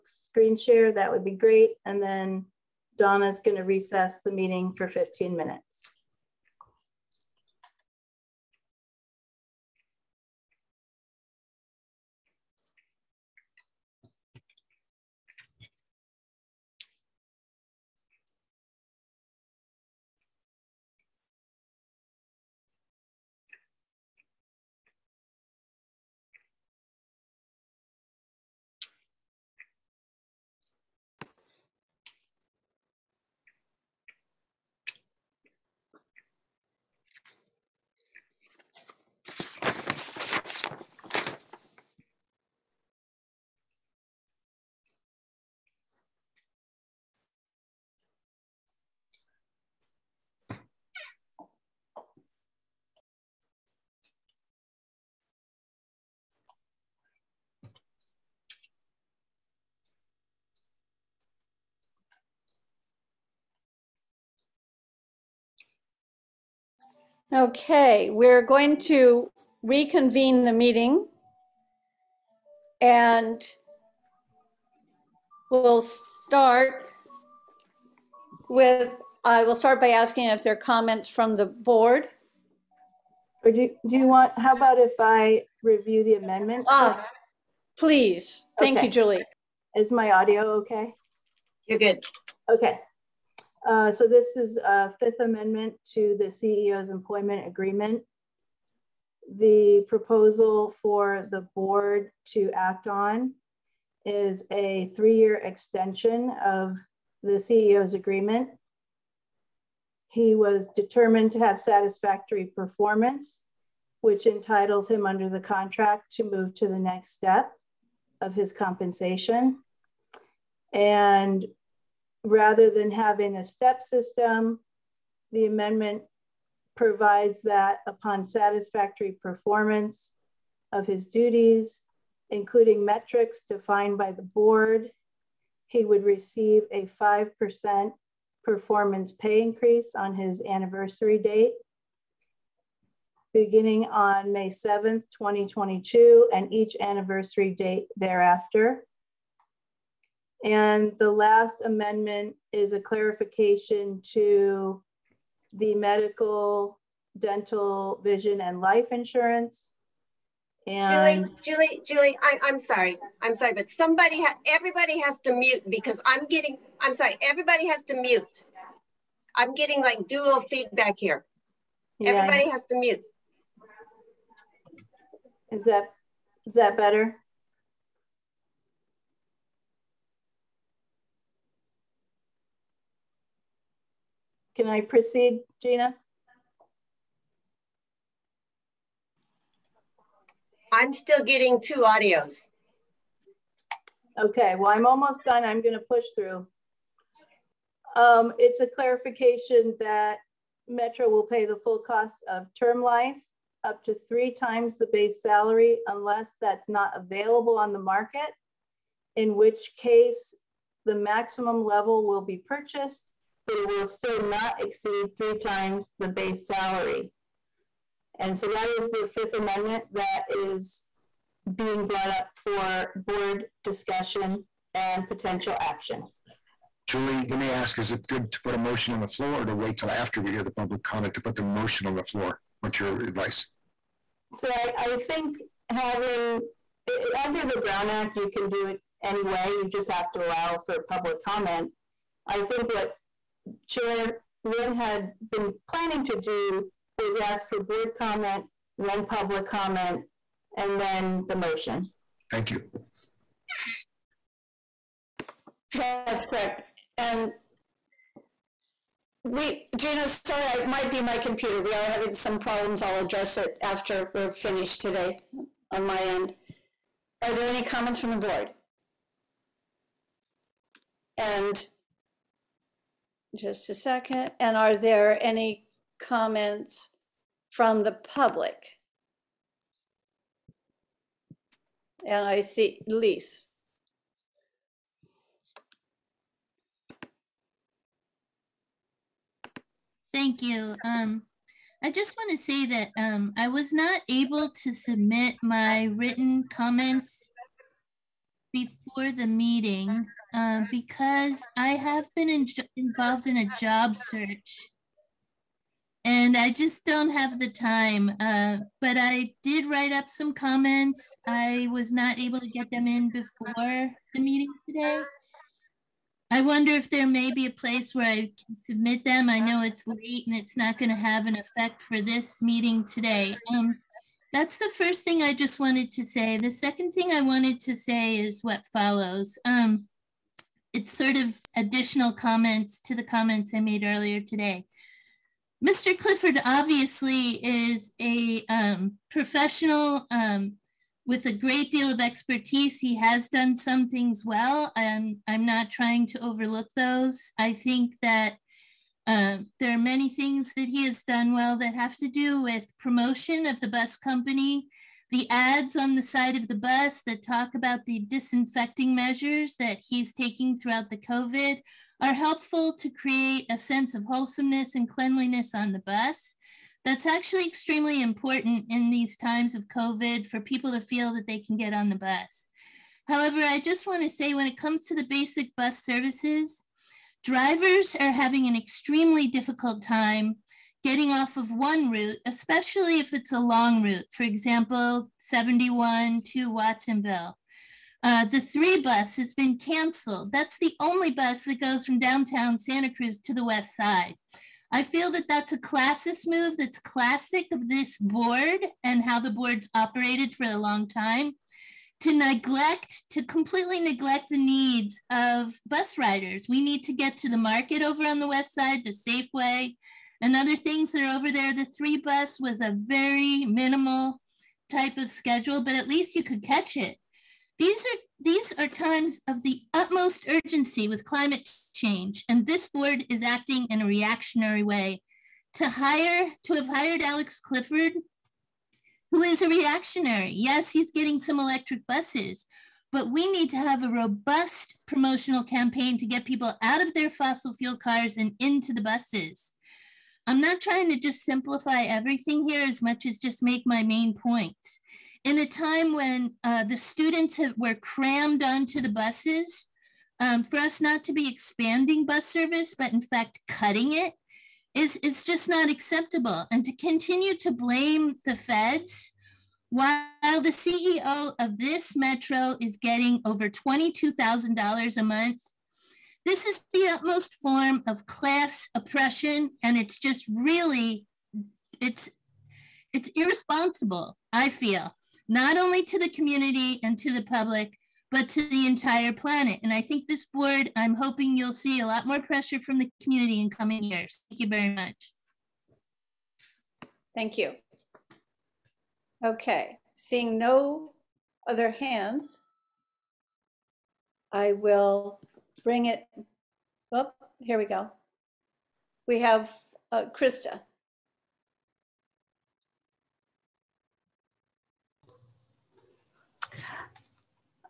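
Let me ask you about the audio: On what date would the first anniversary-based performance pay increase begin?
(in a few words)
May 7th, 2022.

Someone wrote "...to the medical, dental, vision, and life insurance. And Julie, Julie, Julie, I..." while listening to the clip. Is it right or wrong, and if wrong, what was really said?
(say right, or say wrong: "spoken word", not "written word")
right.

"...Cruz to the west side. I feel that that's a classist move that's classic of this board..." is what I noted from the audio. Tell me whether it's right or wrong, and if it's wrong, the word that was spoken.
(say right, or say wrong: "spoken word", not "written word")
right.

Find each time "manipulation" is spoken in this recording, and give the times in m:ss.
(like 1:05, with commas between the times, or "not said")
not said.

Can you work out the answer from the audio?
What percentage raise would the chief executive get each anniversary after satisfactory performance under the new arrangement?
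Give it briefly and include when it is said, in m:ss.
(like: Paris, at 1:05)
5%, at 2:16.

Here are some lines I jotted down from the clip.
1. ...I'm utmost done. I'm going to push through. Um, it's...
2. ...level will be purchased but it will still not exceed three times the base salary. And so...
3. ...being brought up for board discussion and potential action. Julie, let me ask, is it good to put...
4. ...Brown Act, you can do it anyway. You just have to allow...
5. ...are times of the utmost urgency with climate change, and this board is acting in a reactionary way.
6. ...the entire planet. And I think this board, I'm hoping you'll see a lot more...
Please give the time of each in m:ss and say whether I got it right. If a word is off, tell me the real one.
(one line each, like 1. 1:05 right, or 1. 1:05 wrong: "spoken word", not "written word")
1. 3:14 wrong: "almost", not "utmost"
2. 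3:31 right
3. 3:41 right
4. 3:57 right
5. 6:58 right
6. 7:58 right.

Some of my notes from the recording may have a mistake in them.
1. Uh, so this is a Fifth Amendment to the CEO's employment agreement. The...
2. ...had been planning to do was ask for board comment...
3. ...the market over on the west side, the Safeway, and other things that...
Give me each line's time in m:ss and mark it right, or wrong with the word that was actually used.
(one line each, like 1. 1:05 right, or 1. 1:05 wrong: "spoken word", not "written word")
1. 1:33 right
2. 4:04 right
3. 6:47 right.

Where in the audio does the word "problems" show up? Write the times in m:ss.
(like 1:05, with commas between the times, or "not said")
4:22.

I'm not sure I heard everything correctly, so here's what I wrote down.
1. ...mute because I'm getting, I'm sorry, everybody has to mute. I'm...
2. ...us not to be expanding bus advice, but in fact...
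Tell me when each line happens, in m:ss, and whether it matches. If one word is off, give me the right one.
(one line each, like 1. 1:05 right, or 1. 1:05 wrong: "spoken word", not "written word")
1. 2:45 right
2. 7:30 wrong: "service", not "advice".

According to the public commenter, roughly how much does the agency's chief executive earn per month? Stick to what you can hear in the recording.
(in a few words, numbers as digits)
Over $22,000.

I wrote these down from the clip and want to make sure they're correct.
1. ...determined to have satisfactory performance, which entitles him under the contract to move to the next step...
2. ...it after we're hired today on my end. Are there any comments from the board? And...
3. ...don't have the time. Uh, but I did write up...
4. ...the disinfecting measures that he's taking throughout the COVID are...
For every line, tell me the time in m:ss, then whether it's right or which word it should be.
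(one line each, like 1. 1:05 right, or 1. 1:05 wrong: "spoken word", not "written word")
1. 1:50 right
2. 4:23 wrong: "finished", not "hired"
3. 5:06 right
4. 5:57 right.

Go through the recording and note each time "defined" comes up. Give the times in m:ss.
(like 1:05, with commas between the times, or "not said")
2:13.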